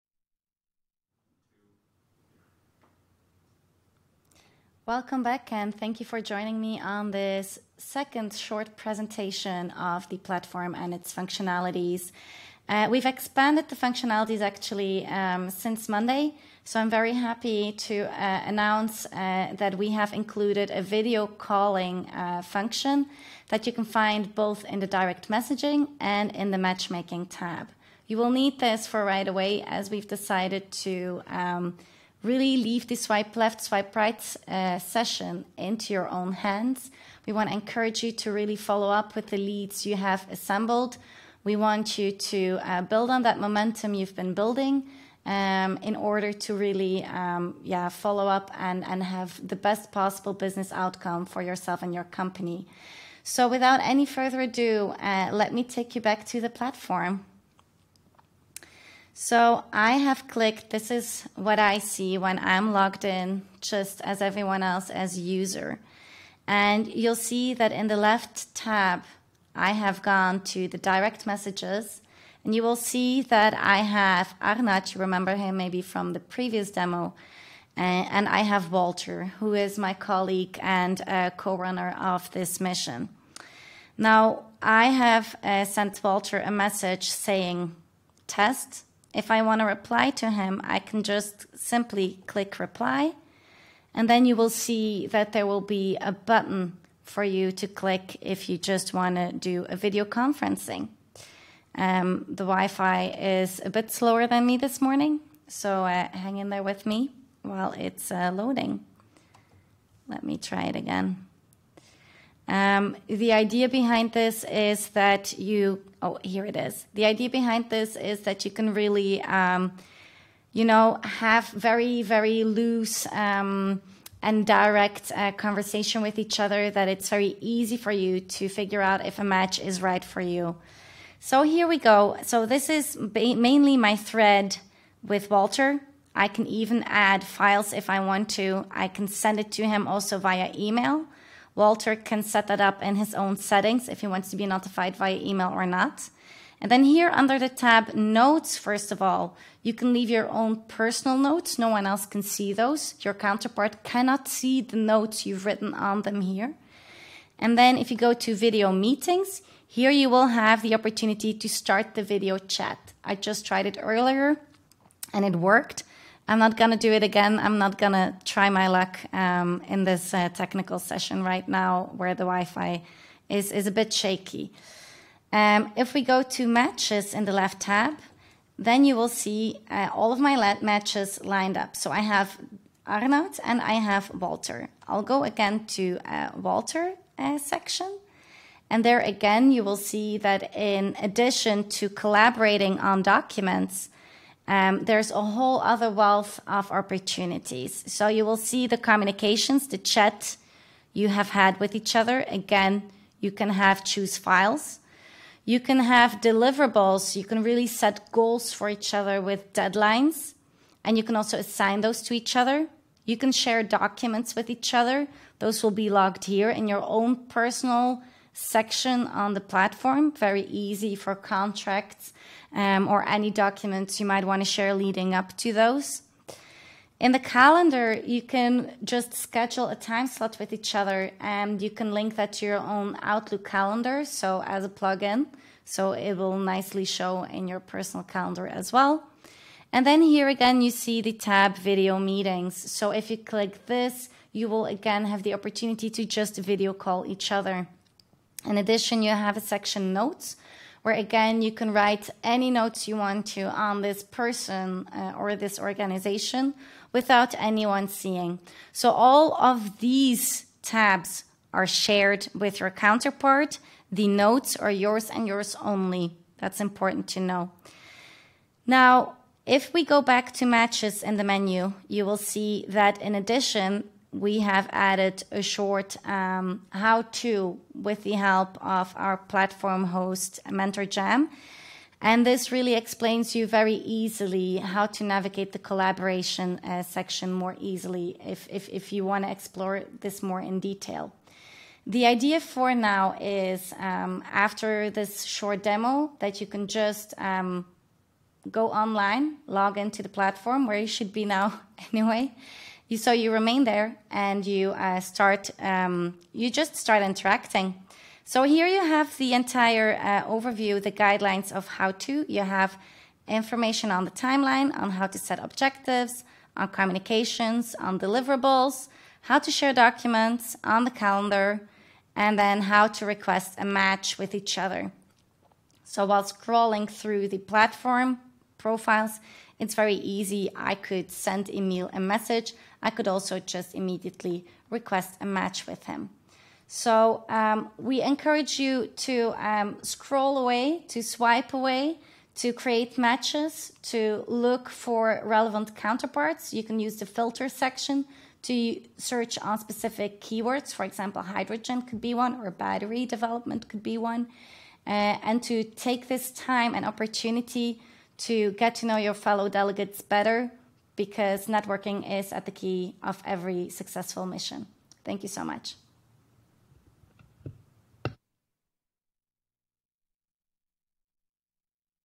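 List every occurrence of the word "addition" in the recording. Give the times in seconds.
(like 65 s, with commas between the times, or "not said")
191 s, 248 s, 273 s.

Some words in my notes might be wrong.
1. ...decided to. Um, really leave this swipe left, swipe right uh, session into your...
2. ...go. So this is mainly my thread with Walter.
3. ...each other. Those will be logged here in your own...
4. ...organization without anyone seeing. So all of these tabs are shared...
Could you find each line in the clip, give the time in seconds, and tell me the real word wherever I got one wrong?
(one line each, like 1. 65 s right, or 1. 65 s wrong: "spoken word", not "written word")
1. 30 s right
2. 131 s right
3. 214 s right
4. 255 s right.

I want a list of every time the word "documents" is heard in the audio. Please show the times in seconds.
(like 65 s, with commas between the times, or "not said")
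193 s, 213 s, 223 s, 319 s.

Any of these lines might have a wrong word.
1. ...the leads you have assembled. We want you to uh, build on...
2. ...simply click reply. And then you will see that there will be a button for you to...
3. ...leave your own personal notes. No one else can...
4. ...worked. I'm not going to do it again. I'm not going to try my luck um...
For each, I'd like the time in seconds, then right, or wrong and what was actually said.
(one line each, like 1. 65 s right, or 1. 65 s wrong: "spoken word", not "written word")
1. 39 s right
2. 91 s right
3. 149 s right
4. 165 s right.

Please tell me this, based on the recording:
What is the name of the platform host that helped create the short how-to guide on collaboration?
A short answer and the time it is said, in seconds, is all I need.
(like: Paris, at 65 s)
Mentor Jam, at 280 s.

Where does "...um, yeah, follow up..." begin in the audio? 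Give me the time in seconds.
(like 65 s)
47 s.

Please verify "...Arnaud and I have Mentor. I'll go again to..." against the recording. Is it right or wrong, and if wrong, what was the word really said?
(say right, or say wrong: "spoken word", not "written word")
wrong: "Walter", not "Mentor".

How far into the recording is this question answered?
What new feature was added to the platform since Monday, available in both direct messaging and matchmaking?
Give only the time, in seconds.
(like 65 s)
20 s.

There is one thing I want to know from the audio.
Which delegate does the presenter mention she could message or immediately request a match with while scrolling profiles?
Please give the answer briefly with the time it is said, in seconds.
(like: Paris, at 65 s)
Emil, at 331 s.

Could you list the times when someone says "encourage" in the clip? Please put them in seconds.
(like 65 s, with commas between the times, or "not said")
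37 s, 338 s.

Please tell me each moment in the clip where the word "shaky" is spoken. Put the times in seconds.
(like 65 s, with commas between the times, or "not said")
173 s.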